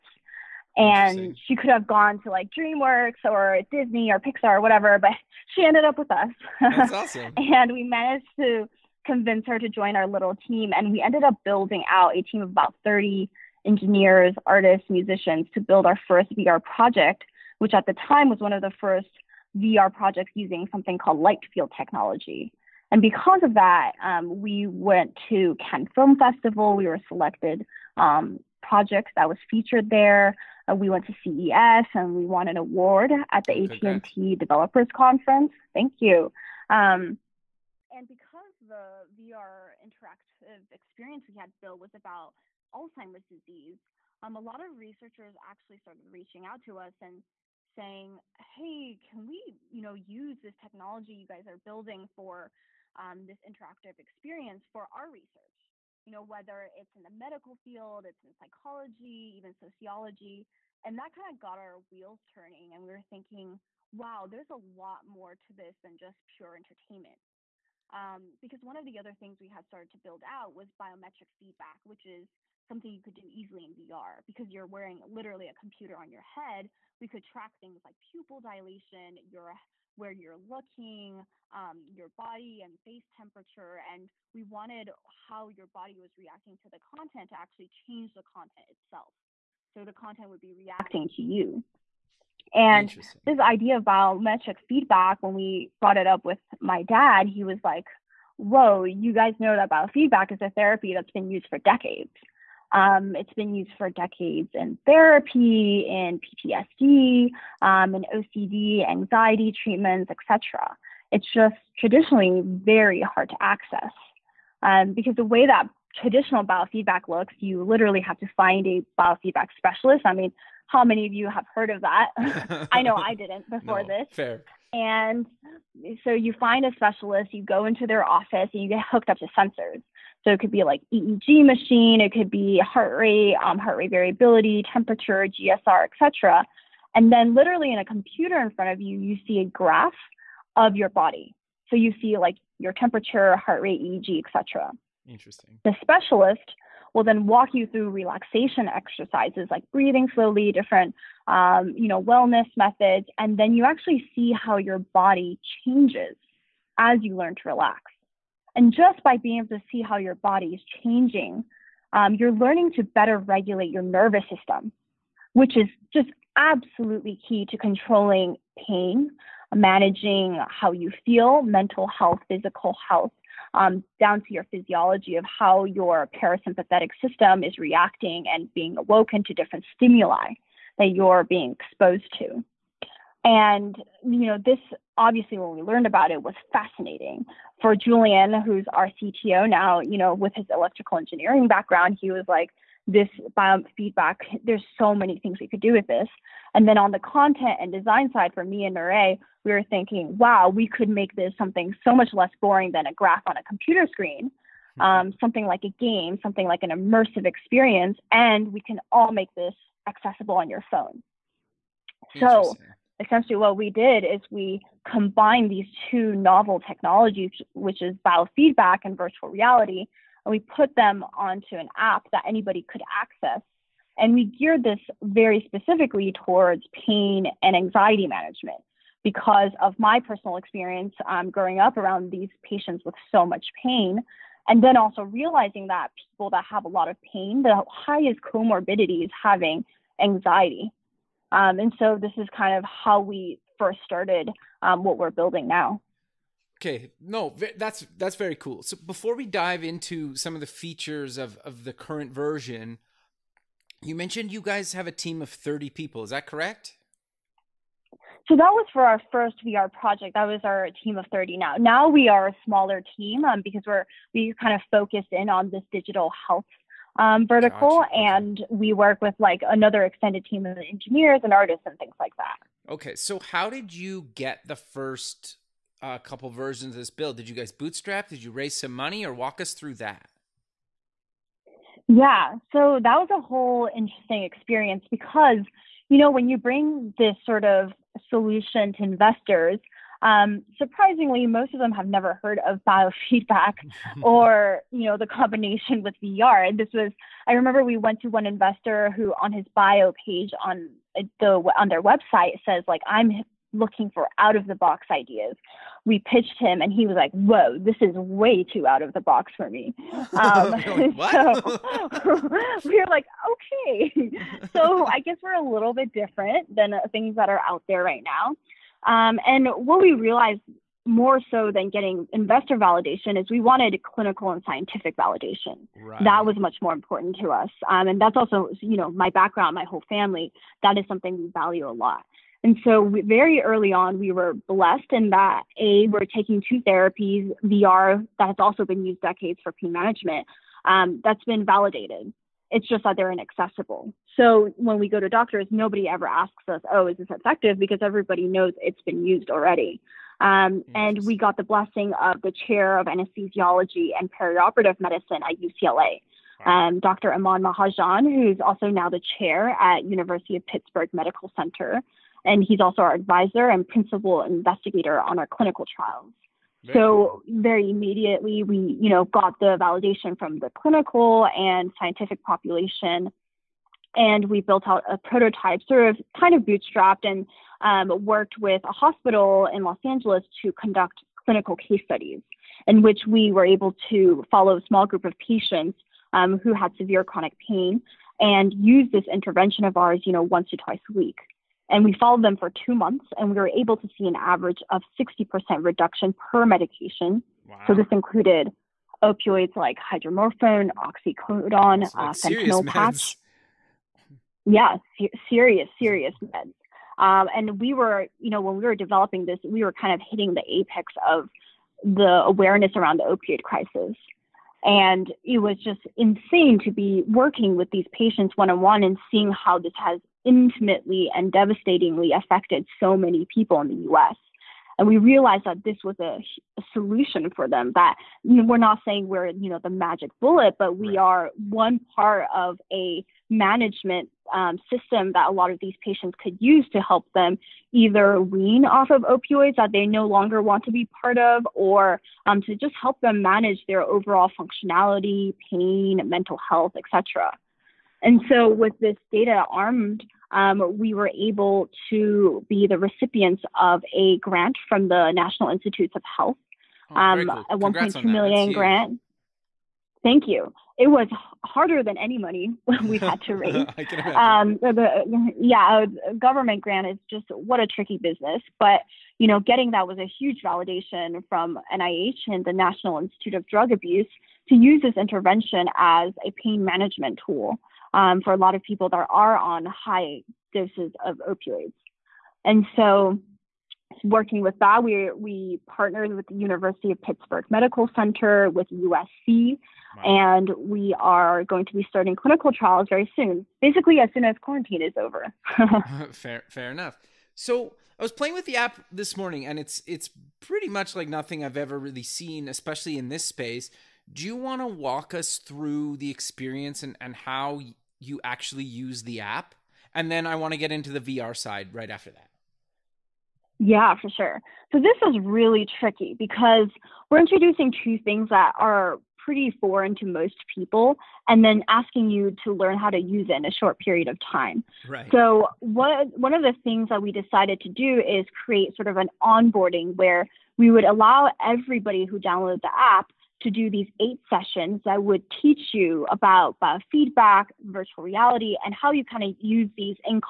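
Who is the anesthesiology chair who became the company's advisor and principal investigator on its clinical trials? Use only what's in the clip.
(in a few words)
Dr. Aman Mahajan.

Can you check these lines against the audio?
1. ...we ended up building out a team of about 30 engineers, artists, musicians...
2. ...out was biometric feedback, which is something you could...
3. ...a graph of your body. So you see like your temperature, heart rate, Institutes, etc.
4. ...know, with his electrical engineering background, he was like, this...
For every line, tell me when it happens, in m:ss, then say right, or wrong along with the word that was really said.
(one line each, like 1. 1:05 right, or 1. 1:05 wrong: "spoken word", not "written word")
1. 0:10 right
2. 1:10 right
3. 2:19 wrong: "EEG", not "Institutes"
4. 3:09 right.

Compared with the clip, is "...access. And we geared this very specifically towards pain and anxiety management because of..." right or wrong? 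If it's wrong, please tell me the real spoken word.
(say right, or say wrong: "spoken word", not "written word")
right.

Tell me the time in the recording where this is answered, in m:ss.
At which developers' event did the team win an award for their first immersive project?
0:33.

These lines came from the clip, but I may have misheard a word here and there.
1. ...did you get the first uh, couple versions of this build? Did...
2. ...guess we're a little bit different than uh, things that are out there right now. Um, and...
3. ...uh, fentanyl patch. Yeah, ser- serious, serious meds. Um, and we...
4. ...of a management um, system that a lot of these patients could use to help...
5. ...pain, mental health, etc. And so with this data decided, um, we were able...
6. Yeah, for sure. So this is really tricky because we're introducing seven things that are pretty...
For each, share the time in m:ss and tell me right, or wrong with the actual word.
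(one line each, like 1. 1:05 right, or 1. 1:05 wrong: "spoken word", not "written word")
1. 4:33 right
2. 5:15 right
3. 6:41 right
4. 7:12 right
5. 7:25 wrong: "armed", not "decided"
6. 8:33 wrong: "two", not "seven".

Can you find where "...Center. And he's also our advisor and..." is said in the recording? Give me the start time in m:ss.
6:01.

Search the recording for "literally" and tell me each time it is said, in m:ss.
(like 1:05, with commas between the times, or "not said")
1:15, 1:57, 2:17.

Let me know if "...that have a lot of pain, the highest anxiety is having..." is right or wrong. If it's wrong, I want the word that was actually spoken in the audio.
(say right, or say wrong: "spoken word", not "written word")
wrong: "comorbidity", not "anxiety".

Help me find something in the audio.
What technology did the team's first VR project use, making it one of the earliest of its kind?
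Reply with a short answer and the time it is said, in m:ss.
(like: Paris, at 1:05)
Light field technology, at 0:21.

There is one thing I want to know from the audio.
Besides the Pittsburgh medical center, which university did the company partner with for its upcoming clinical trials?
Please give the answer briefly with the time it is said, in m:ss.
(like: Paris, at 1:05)
USC, at 8:08.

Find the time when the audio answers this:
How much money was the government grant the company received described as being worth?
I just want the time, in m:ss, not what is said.
7:37.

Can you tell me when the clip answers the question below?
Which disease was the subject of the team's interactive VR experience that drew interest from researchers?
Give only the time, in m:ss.
0:42.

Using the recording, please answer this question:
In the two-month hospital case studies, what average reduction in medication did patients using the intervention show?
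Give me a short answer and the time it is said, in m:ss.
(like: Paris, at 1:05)
60%, at 6:34.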